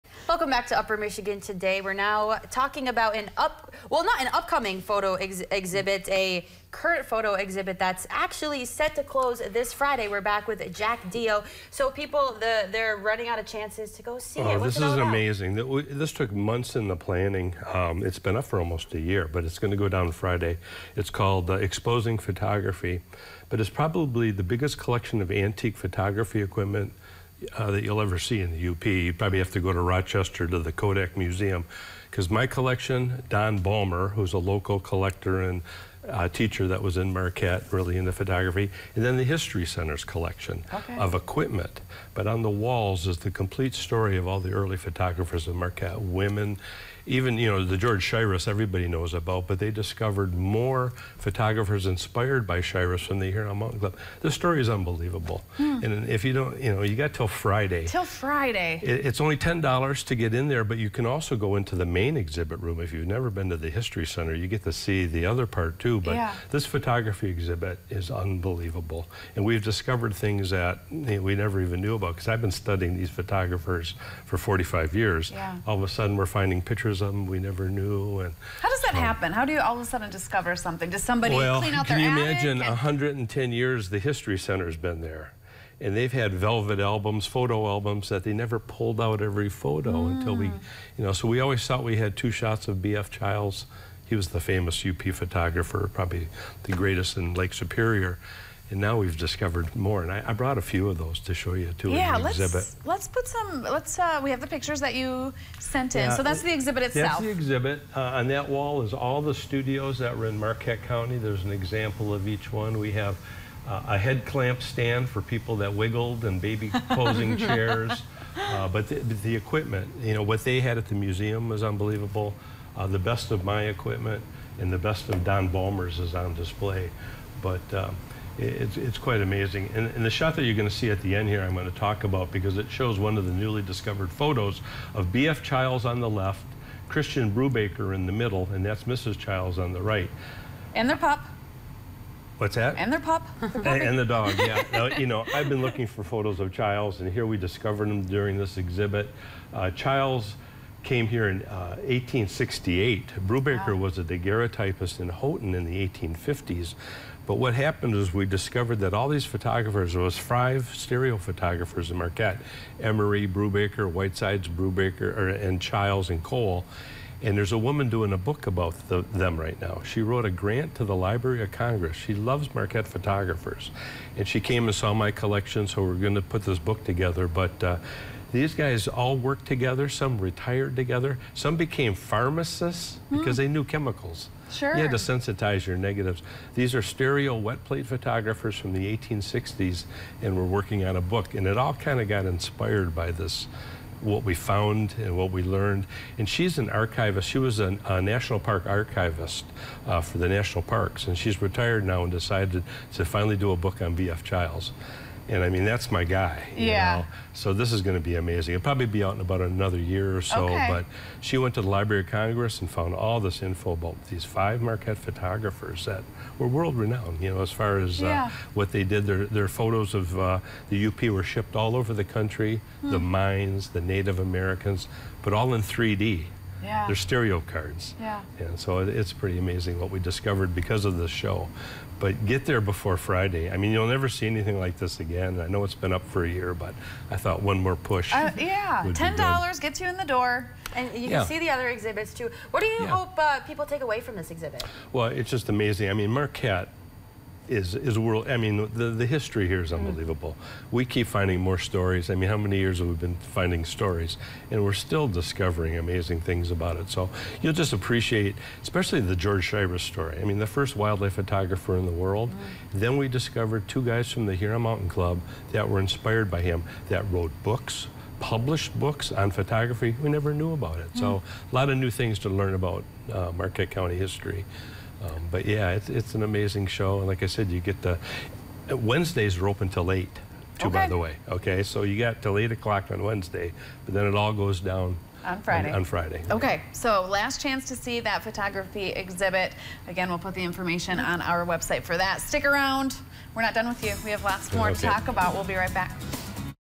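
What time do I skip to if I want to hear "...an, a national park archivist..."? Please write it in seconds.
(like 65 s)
197 s.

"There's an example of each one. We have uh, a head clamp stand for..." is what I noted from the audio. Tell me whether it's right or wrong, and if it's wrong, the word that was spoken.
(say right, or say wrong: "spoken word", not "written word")
right.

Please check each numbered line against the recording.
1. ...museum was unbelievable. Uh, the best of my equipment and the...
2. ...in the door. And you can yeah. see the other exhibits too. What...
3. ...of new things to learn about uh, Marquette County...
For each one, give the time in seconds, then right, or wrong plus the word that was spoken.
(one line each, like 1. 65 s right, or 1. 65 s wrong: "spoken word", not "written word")
1. 120 s right
2. 239 s right
3. 271 s right.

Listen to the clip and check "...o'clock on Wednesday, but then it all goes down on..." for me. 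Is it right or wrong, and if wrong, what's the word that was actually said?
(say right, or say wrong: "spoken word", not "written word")
right.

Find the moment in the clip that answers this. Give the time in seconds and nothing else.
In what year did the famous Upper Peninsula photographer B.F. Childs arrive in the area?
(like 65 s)
151 s.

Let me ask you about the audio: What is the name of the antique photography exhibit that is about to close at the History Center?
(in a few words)
Exposing Photography.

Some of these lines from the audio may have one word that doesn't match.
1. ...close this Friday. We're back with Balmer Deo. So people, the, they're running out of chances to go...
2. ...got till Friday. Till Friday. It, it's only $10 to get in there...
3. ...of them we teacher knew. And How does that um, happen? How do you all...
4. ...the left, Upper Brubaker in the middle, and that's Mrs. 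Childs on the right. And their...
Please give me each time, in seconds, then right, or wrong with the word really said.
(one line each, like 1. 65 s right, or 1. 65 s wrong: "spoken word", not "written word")
1. 9 s wrong: "Jack", not "Balmer"
2. 56 s right
3. 77 s wrong: "never", not "teacher"
4. 135 s wrong: "Christian", not "Upper".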